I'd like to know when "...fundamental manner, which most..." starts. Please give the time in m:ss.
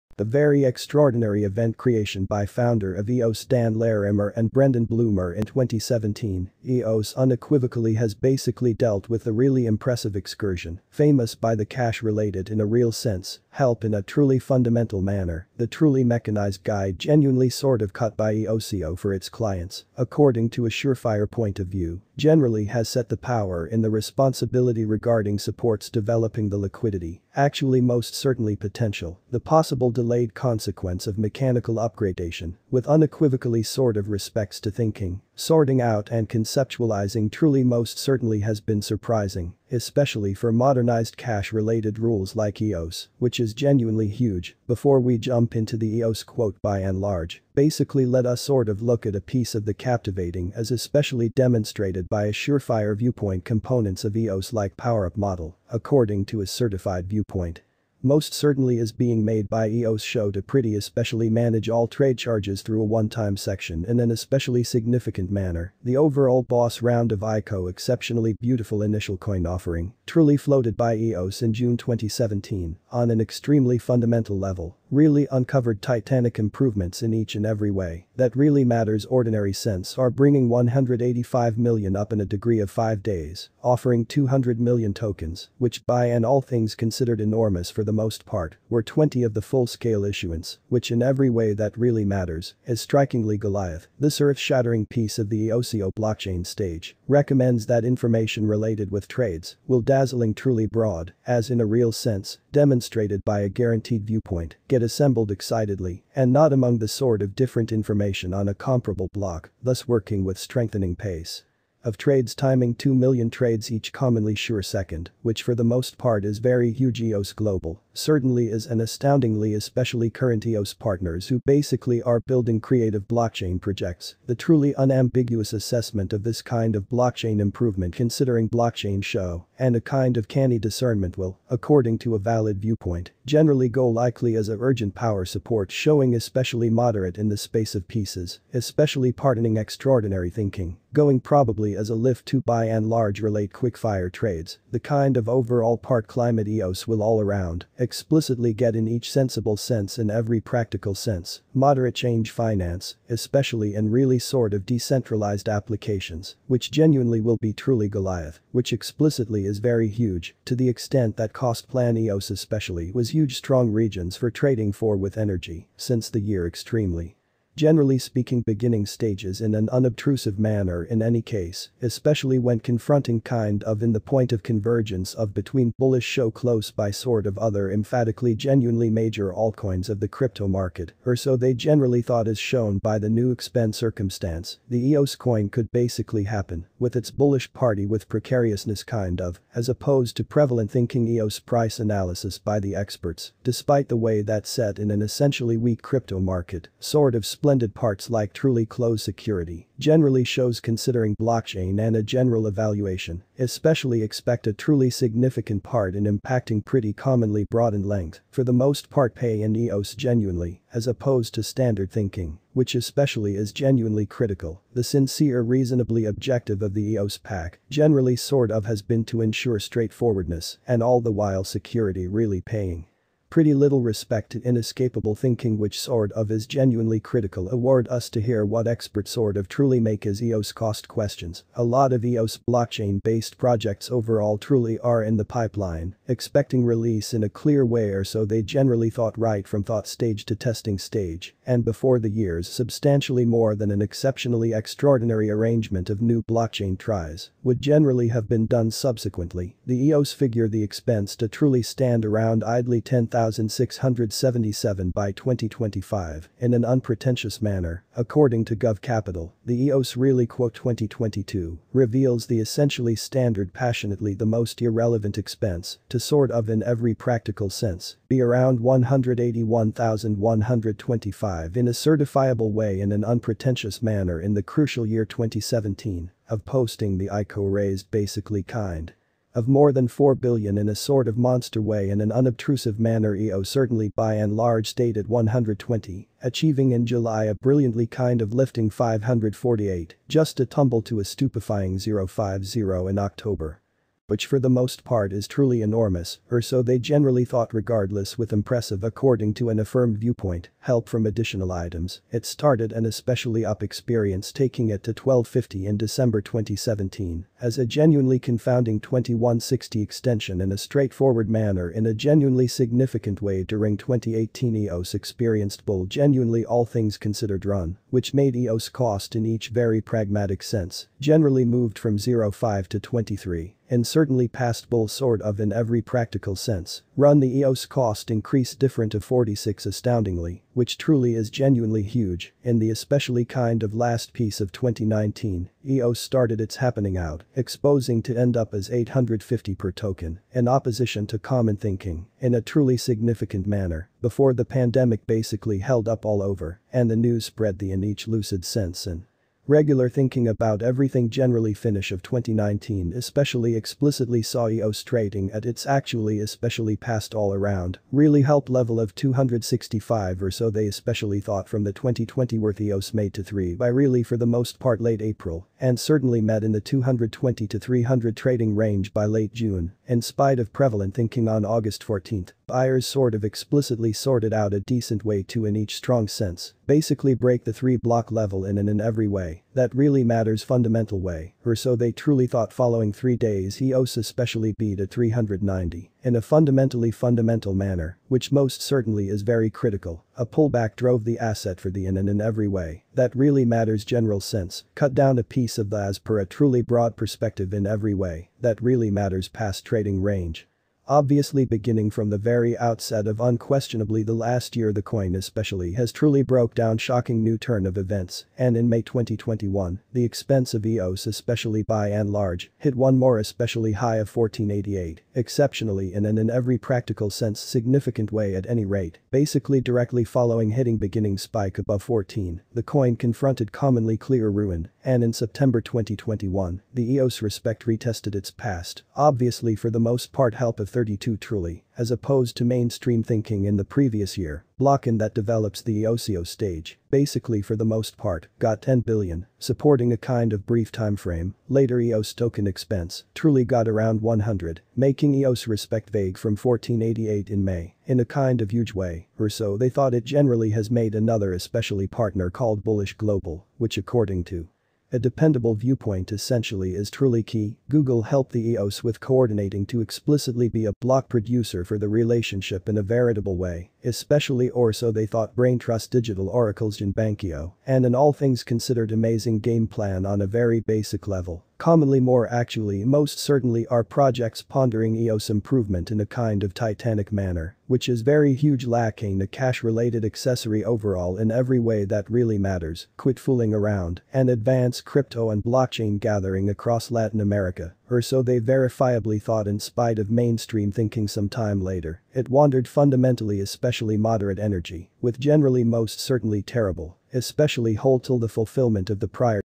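6:26.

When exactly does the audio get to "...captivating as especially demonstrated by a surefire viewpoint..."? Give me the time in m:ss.
0:49.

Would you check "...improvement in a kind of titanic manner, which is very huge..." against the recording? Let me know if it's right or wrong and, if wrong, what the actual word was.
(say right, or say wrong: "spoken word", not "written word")
right.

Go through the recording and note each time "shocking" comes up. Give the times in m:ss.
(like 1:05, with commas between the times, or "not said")
6:46.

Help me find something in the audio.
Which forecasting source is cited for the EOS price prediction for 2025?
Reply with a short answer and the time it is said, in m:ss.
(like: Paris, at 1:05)
Gov Capital, at 4:18.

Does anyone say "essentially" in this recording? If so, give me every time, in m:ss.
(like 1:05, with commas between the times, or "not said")
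3:15, 4:22, 7:36.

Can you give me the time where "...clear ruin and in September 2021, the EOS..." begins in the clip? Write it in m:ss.
7:03.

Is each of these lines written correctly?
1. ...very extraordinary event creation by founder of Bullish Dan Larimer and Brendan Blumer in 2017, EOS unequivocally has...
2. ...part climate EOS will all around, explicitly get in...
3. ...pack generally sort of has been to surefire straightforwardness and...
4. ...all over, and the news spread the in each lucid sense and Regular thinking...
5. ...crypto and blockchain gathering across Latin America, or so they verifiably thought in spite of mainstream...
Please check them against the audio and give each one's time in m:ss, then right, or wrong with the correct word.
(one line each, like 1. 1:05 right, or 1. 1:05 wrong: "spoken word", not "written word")
1. 0:00 wrong: "EOS", not "Bullish"
2. 2:25 right
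3. 3:37 wrong: "ensure", not "surefire"
4. 5:46 right
5. 8:04 right.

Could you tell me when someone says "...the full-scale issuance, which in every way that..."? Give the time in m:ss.
1:29.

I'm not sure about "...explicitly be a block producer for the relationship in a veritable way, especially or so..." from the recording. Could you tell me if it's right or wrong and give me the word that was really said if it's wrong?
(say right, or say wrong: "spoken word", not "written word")
right.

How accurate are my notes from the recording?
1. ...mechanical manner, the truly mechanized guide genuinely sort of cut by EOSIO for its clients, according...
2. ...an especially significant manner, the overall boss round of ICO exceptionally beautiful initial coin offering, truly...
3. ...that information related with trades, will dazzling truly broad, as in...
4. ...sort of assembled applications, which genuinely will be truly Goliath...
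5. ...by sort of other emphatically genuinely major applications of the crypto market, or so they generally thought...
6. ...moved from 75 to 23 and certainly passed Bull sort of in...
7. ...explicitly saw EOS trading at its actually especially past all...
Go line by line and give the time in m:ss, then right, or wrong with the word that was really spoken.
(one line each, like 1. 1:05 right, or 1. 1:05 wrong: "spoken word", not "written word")
1. 0:14 wrong: "fundamental", not "mechanical"
2. 1:03 right
3. 1:37 right
4. 2:34 wrong: "decentralized", not "assembled"
5. 2:56 wrong: "altcoins", not "applications"
6. 5:21 wrong: "05", not "75"
7. 5:53 right.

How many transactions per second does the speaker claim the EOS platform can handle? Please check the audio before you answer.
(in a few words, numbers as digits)
2 million.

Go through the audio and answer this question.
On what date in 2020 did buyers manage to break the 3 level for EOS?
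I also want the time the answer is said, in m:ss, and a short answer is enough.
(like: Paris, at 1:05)
August 14, at 6:11.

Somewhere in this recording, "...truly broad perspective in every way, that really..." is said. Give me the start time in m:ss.
6:36.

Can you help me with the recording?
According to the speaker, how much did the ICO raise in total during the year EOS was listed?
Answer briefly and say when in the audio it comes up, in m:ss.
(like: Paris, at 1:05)
more than 4 billion, at 4:39.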